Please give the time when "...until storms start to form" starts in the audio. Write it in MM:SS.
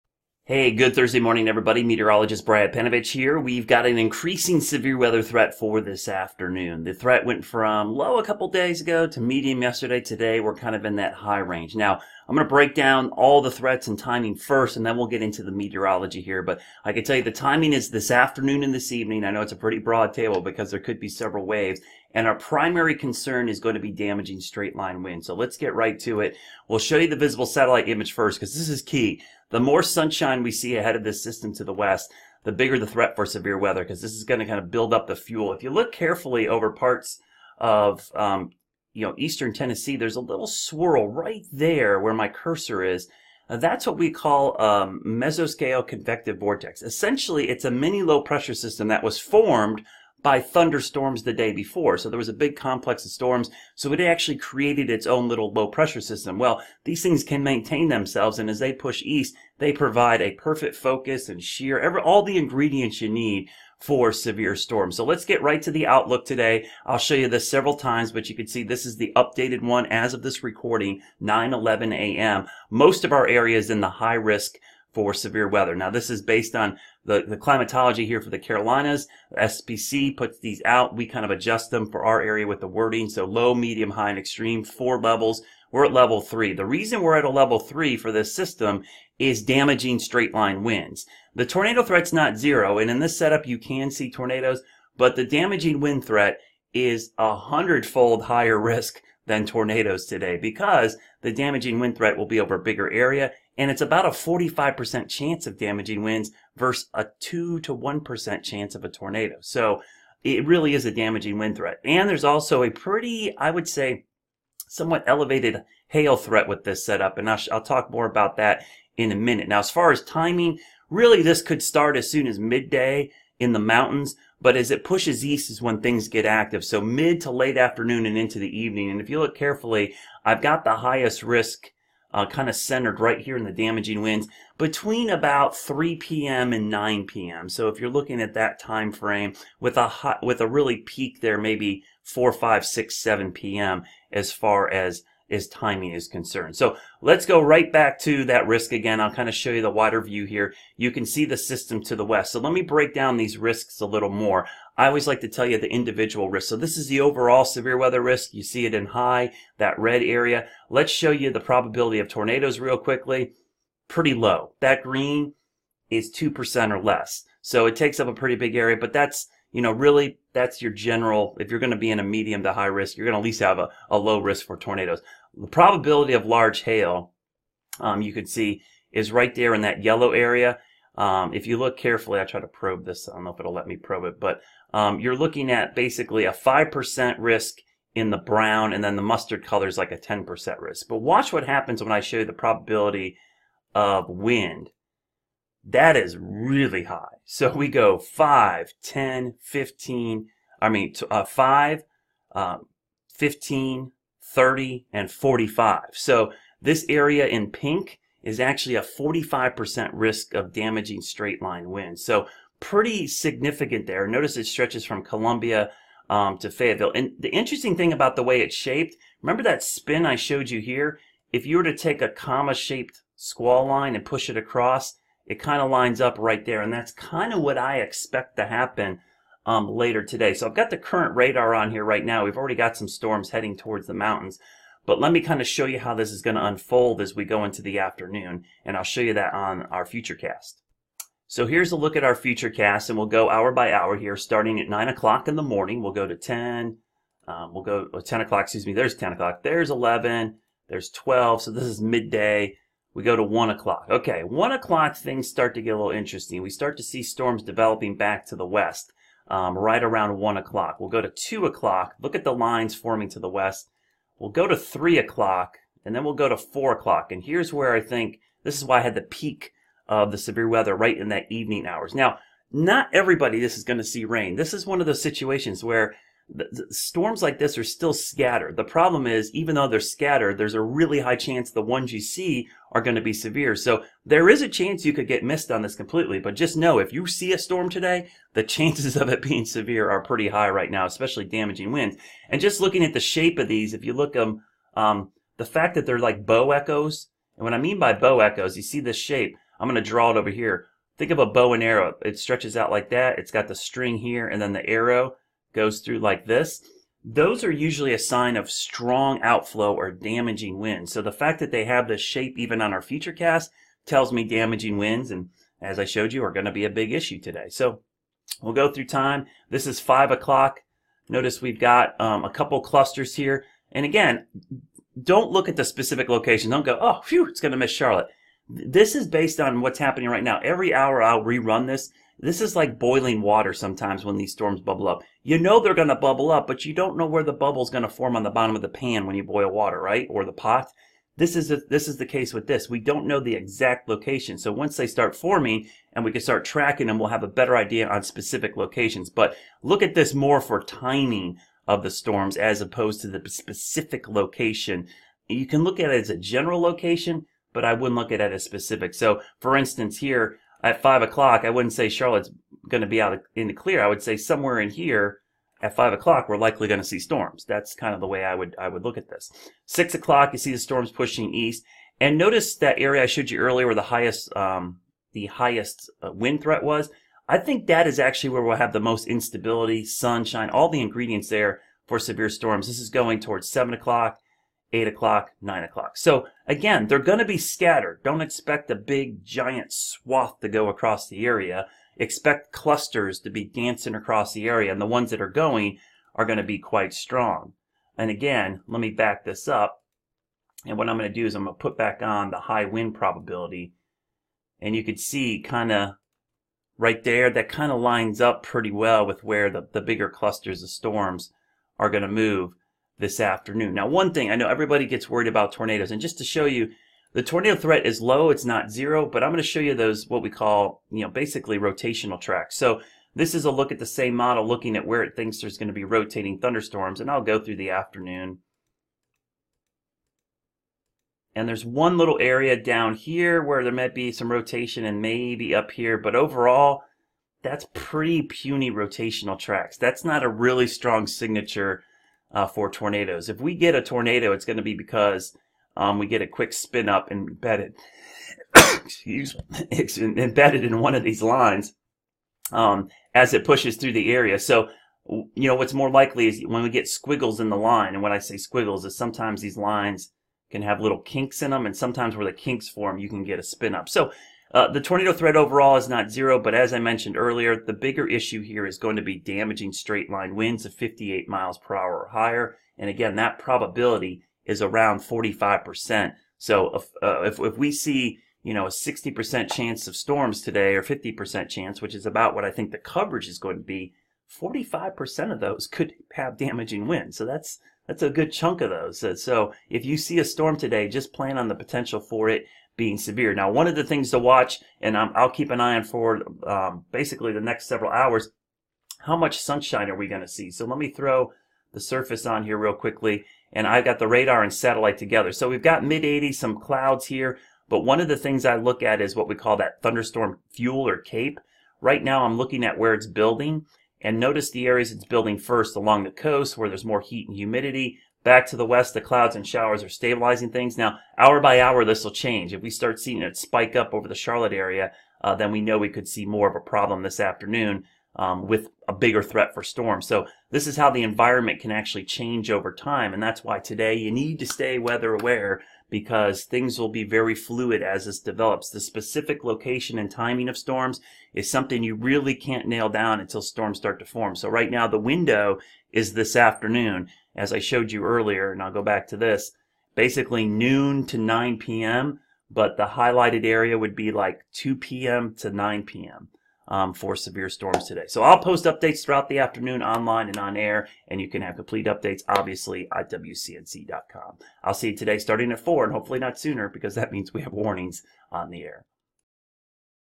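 09:03.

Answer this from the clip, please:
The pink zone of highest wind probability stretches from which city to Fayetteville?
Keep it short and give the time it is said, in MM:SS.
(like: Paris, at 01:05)
Columbia, at 03:35.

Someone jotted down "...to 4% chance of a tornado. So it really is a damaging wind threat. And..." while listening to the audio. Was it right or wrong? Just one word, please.
wrong.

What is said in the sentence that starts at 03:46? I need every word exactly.
And that's kind of what I expect to happen um, later today.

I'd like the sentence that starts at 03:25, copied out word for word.
So this area in pink is actually a 45% risk of damaging straight line winds.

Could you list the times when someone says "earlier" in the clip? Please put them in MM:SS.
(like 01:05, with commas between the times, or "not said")
06:13, 07:47, 09:08.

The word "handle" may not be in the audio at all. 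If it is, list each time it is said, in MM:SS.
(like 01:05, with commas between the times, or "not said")
not said.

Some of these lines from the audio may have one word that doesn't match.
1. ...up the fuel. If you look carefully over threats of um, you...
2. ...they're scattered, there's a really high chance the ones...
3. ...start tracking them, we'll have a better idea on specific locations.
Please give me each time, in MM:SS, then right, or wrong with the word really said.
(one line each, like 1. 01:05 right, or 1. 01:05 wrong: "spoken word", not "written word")
1. 00:34 wrong: "parts", not "threats"
2. 04:39 right
3. 05:46 right.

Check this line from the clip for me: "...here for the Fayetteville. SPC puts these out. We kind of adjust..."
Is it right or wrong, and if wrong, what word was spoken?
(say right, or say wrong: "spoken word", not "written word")
wrong: "Carolinas", not "Fayetteville".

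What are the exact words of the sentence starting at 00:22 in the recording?
And our primary concern is going to be damaging straight line wind.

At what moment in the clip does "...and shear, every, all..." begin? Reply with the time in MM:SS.
01:01.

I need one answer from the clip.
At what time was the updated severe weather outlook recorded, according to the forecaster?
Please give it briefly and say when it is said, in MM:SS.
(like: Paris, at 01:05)
9:11 a.m., at 01:11.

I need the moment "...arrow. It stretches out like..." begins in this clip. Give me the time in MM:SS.
05:01.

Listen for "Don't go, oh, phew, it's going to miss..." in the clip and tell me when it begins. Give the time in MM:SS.
05:26.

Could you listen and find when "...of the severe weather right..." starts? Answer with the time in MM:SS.
04:29.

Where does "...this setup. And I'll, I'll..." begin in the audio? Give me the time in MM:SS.
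01:56.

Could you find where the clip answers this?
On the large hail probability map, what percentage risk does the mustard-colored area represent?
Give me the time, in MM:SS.
03:09.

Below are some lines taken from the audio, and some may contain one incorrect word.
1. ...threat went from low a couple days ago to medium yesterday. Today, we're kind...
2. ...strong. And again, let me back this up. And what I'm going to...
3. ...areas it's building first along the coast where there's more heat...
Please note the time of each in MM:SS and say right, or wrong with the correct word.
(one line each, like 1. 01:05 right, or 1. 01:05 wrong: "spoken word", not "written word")
1. 00:06 right
2. 06:36 right
3. 08:34 right.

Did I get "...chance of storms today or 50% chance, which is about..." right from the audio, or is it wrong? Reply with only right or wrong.
right.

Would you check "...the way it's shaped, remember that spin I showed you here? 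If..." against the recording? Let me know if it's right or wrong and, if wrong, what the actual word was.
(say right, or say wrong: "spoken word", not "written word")
right.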